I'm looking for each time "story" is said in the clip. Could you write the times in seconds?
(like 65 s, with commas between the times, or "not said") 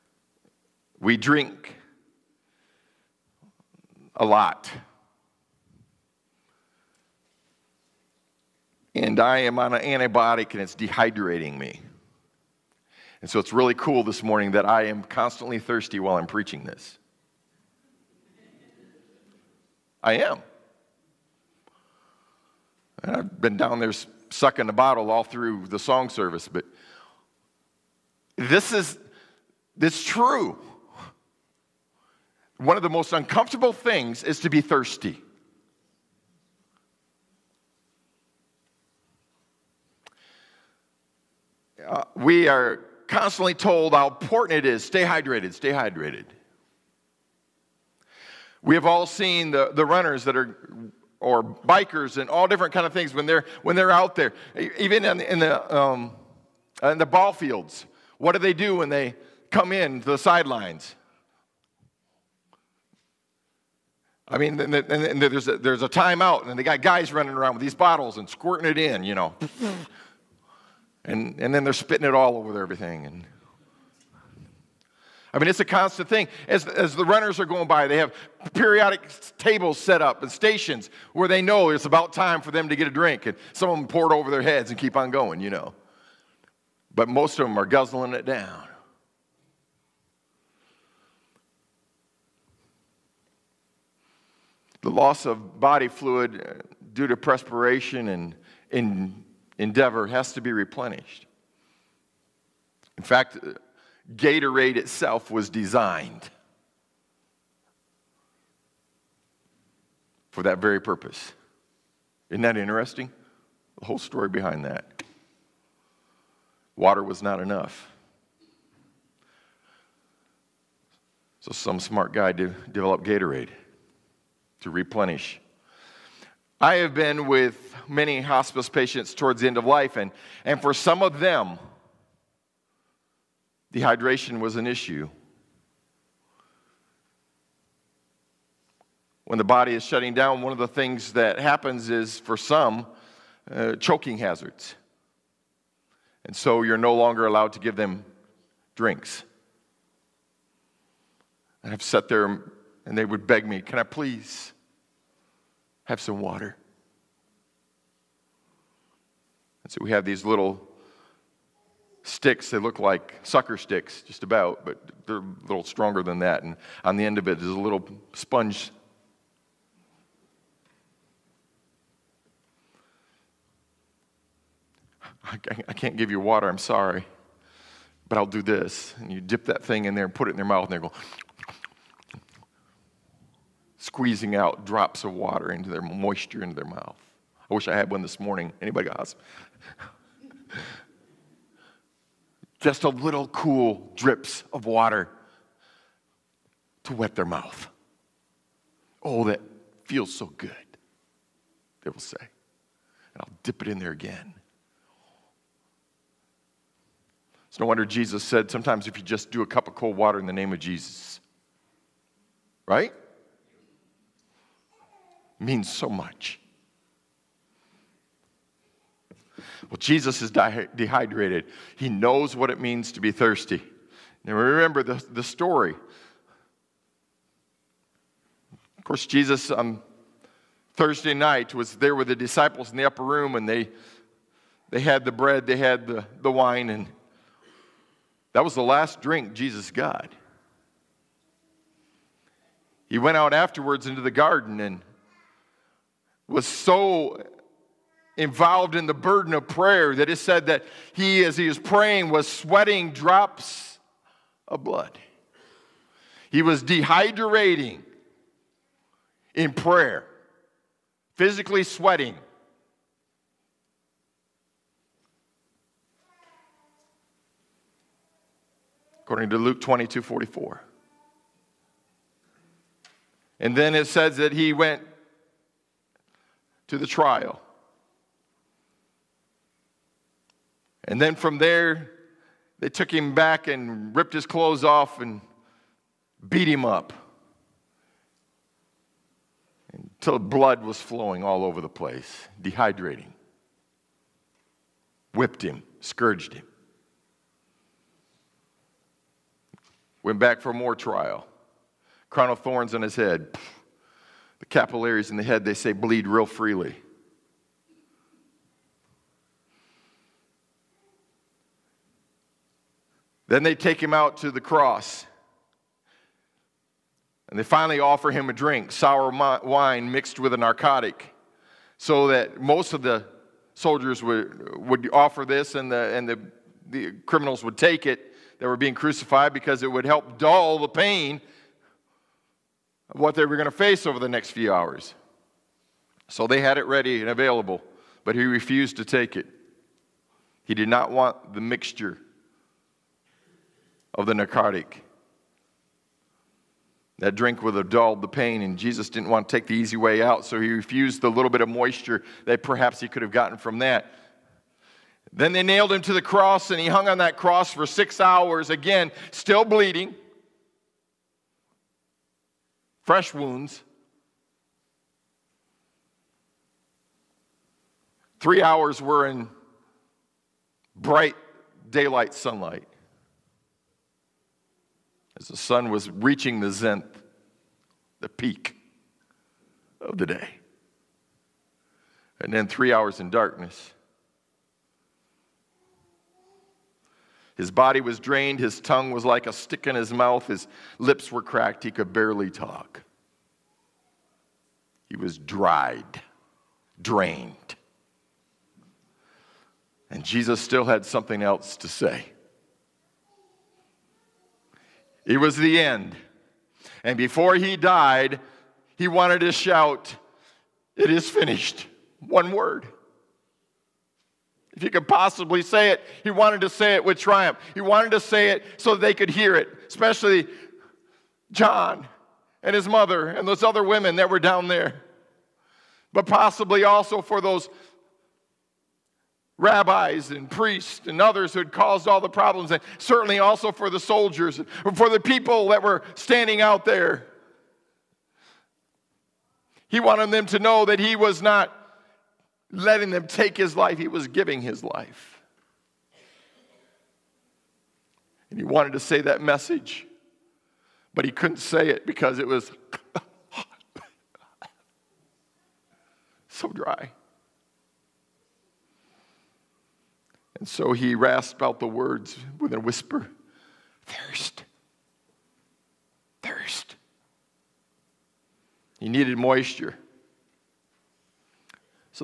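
113 s, 225 s.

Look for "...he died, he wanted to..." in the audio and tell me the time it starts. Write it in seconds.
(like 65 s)
407 s.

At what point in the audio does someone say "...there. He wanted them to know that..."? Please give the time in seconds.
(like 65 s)
436 s.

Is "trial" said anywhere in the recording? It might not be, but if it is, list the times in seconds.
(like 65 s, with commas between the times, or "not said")
276 s, 300 s.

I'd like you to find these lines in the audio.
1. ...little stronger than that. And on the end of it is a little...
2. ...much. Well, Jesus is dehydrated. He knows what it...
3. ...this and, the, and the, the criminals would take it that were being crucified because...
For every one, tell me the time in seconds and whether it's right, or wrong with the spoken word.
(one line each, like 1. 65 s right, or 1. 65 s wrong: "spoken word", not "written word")
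1. 165 s right
2. 215 s right
3. 325 s right.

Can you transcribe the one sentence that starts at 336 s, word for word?
So they had it ready and available, but he refused to take it.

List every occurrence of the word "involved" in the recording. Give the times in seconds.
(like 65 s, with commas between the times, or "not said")
248 s.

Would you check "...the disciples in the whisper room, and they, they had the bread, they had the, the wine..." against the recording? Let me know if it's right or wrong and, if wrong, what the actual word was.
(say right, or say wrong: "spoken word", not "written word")
wrong: "upper", not "whisper".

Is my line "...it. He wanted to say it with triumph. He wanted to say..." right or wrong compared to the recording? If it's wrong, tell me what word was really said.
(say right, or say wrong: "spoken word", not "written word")
right.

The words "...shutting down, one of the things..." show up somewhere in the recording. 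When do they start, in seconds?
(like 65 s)
139 s.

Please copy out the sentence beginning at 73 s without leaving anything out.
And I mean, it's a constant thing.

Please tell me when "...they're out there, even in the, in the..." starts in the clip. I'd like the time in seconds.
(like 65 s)
53 s.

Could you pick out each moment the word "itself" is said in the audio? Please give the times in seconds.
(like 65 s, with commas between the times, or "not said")
104 s.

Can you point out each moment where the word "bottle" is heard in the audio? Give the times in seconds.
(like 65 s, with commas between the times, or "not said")
24 s, 67 s.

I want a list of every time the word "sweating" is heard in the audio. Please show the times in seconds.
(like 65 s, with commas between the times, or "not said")
252 s, 261 s.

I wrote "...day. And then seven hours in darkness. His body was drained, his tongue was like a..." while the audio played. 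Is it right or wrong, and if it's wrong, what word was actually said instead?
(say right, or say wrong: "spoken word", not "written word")
wrong: "three", not "seven".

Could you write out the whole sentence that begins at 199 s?
Oh, that feels so good, they will say.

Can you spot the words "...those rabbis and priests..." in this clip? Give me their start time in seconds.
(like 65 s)
427 s.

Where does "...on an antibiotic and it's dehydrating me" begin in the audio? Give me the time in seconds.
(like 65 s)
9 s.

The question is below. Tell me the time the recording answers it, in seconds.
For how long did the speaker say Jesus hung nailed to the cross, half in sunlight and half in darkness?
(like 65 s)
357 s.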